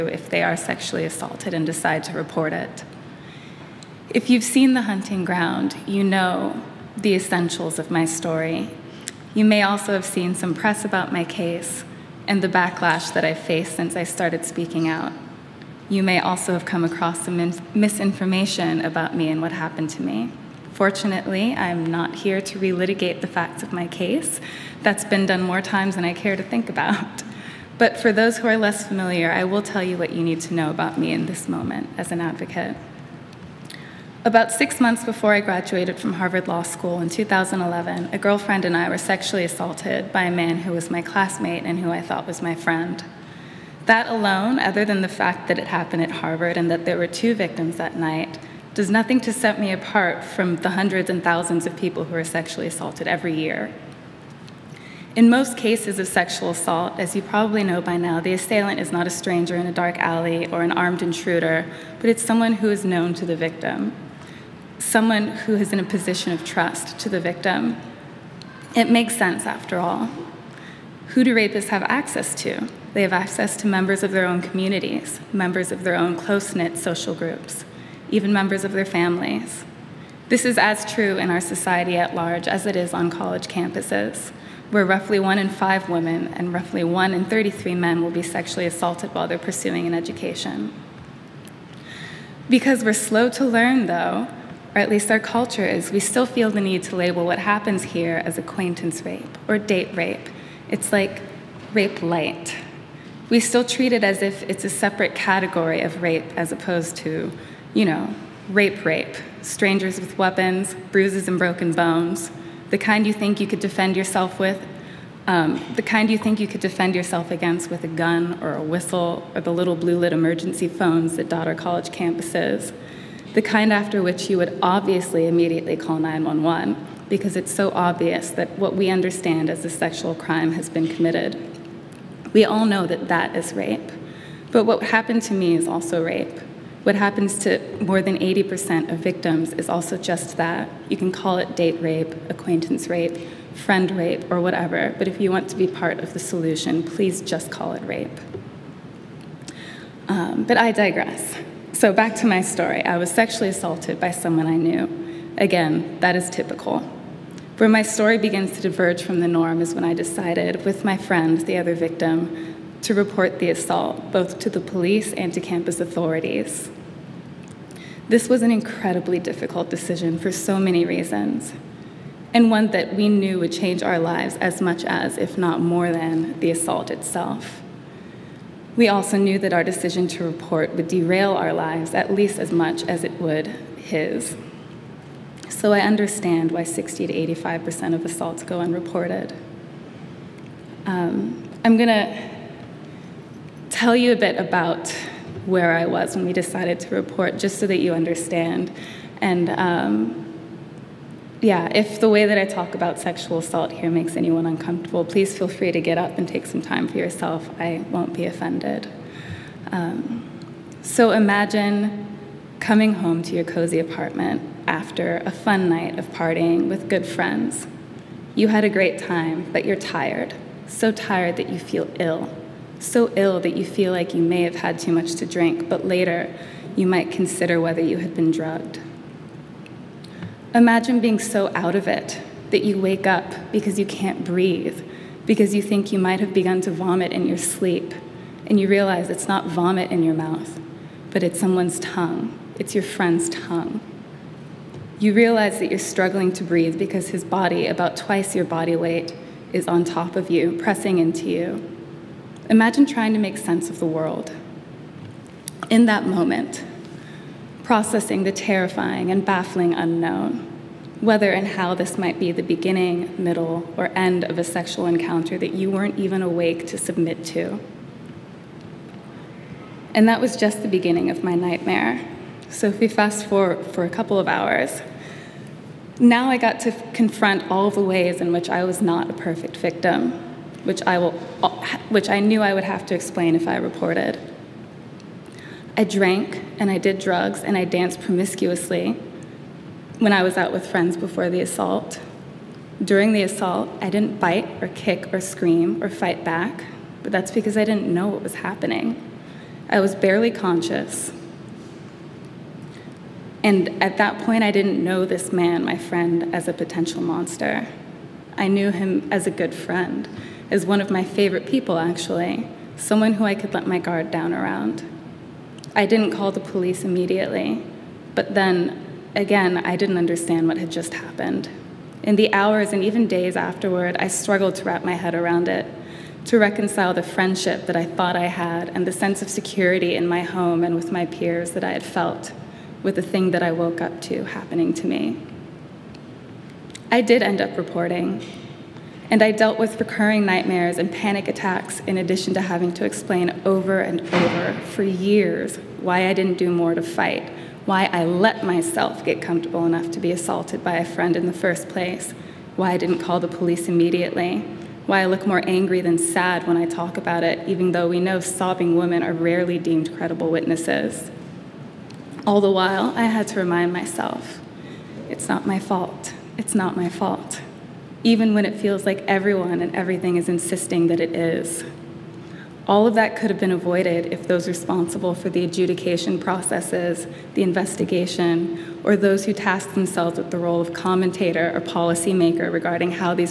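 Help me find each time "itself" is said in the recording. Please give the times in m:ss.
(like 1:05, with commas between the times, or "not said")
2:56.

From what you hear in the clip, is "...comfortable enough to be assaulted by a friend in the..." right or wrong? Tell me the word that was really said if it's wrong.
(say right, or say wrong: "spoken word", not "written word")
right.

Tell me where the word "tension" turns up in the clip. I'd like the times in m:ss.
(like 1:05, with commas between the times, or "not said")
not said.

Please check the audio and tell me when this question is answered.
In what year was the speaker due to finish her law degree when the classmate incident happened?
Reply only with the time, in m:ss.
0:37.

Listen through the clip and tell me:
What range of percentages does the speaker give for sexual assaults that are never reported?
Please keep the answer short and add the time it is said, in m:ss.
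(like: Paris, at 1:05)
60 to 85%, at 3:06.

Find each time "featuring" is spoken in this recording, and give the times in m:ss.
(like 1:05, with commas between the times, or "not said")
not said.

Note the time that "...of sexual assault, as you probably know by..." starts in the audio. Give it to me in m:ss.
0:55.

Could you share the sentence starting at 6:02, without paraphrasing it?
All the while, I had to remind myself it's not my fault.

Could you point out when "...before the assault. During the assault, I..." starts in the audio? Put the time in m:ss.
4:50.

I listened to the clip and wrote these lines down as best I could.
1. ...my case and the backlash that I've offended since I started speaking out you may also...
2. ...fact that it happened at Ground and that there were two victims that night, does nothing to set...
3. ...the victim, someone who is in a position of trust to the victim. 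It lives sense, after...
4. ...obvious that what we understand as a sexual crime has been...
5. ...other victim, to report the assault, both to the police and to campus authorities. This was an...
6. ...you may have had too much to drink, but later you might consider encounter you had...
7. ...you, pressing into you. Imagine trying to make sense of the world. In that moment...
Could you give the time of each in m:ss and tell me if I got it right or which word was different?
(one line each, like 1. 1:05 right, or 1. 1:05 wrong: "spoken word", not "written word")
1. 0:11 wrong: "faced", not "offended"
2. 0:45 wrong: "Harvard", not "Ground"
3. 1:03 wrong: "makes", not "lives"
4. 2:07 right
5. 2:41 right
6. 3:44 wrong: "whether", not "encounter"
7. 4:10 right.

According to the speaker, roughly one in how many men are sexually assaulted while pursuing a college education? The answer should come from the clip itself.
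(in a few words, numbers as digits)
33.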